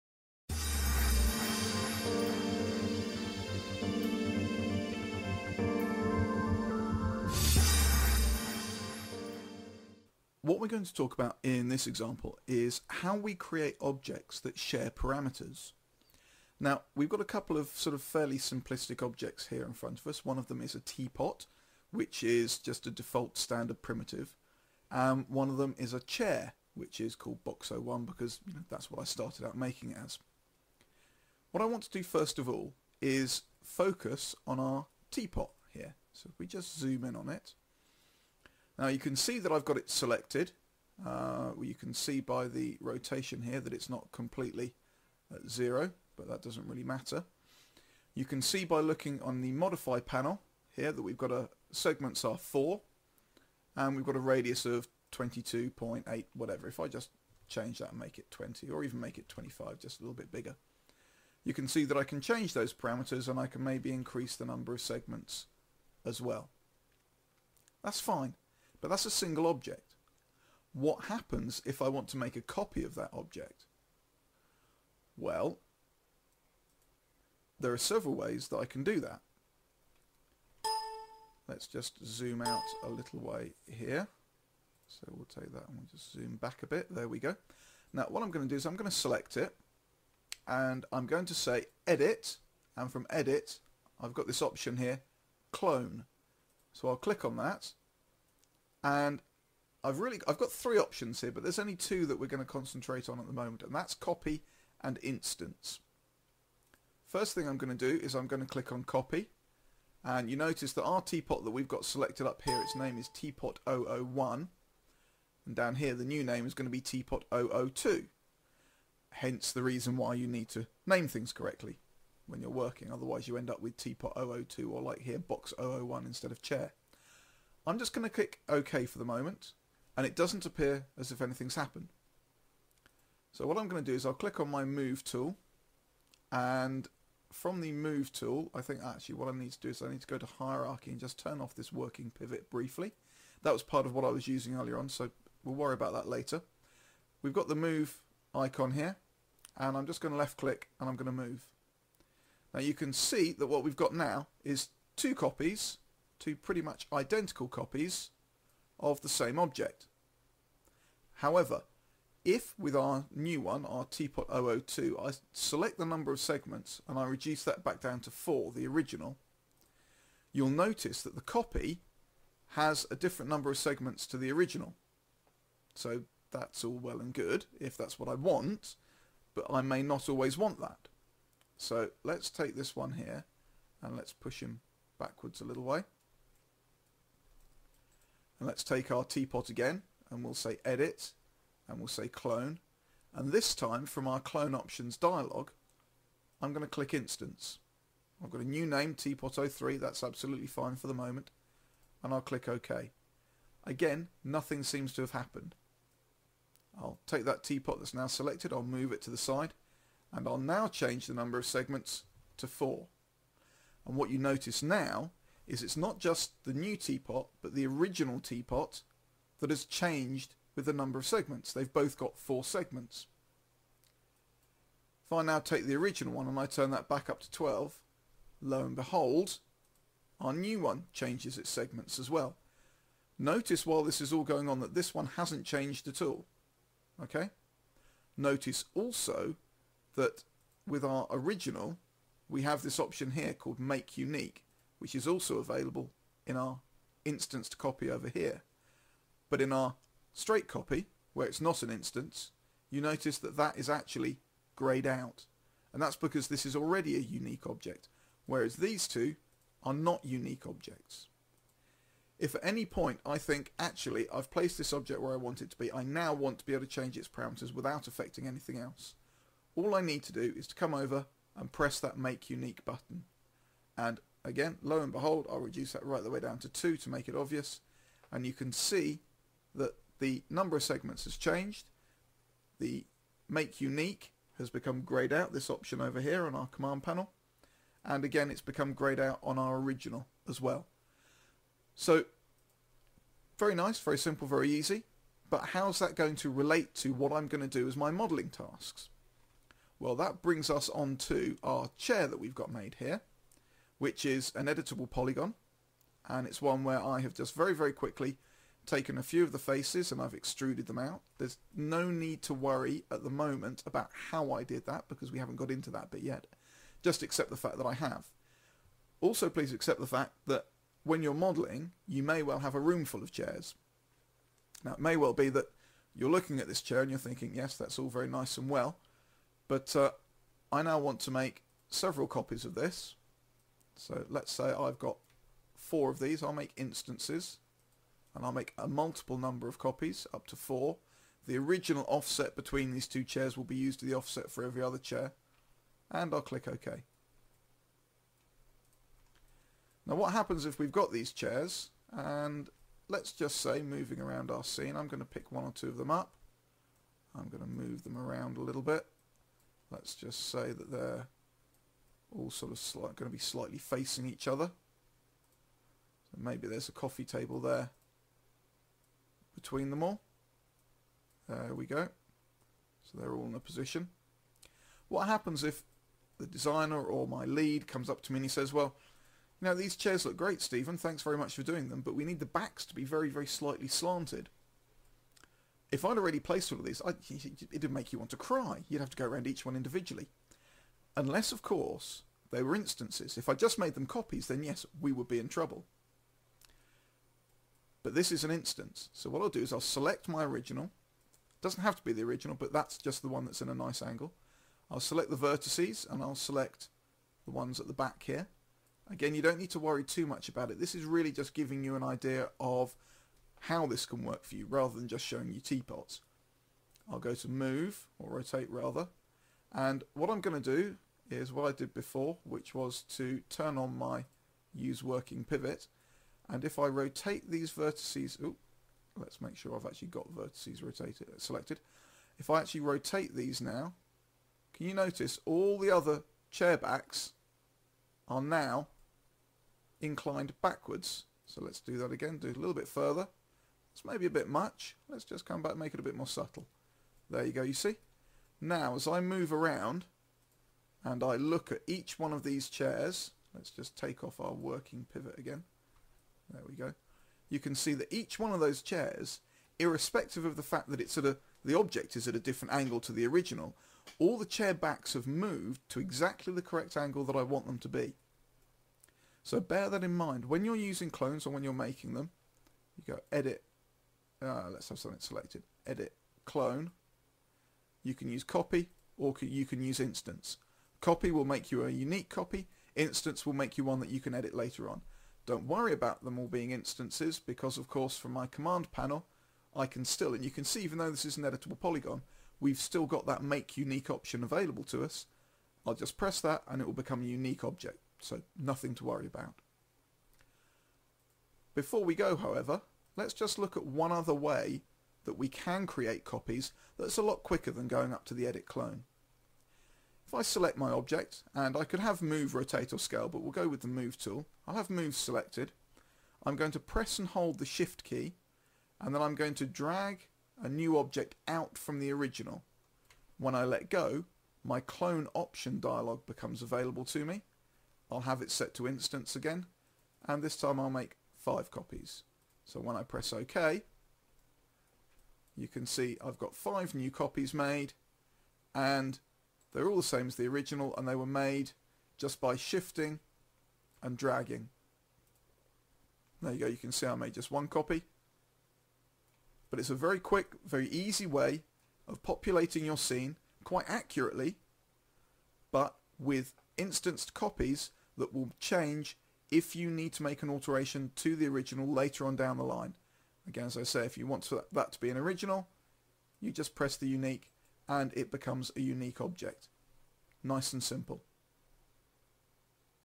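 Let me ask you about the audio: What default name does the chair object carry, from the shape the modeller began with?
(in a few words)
Box01.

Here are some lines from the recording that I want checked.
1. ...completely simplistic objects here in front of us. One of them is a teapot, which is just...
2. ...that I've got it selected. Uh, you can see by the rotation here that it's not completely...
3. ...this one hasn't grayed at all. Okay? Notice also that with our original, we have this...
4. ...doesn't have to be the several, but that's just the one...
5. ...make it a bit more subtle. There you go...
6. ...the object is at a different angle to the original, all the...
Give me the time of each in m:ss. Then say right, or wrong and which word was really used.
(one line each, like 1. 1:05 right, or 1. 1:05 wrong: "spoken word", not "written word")
1. 0:18 wrong: "fairly", not "completely"
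2. 0:39 right
3. 3:54 wrong: "changed", not "grayed"
4. 6:41 wrong: "original", not "several"
5. 7:25 right
6. 7:41 right.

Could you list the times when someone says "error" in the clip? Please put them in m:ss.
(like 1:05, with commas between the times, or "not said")
not said.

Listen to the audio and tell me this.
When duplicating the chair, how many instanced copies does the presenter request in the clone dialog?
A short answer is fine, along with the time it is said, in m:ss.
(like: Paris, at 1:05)
4, at 5:40.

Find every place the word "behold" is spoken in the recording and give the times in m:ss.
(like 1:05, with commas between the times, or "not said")
3:48, 4:34.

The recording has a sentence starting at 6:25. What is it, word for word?
If I'd already placed all of these, I, it'd make you want to cry.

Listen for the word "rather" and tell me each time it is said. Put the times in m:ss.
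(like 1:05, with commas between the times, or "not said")
6:54, 6:58.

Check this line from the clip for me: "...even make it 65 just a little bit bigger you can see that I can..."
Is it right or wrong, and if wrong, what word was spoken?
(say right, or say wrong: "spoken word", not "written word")
wrong: "25", not "65".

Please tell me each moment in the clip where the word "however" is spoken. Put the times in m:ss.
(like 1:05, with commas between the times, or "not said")
2:41, 8:22.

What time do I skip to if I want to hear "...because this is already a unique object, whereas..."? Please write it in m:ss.
4:15.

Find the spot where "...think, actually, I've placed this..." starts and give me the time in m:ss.
4:23.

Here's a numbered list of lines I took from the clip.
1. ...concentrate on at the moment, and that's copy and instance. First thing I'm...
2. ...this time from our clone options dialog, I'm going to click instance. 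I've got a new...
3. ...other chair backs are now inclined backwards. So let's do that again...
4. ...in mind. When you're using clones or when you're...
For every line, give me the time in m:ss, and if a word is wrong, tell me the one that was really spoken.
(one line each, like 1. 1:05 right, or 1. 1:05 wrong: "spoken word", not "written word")
1. 1:42 right
2. 3:13 right
3. 7:15 right
4. 7:49 right.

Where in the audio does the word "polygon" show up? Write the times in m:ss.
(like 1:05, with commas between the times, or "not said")
5:04, 8:11.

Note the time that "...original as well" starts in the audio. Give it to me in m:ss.
4:49.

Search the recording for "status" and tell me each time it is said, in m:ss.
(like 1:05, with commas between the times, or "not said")
not said.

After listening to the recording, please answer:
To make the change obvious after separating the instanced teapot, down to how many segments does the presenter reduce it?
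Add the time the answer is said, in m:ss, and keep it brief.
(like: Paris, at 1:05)
2, at 4:36.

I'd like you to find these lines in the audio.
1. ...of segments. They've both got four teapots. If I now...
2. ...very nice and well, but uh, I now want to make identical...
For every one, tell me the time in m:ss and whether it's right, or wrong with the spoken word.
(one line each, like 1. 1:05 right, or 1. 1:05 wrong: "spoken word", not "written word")
1. 3:40 wrong: "segments", not "teapots"
2. 5:27 wrong: "several", not "identical".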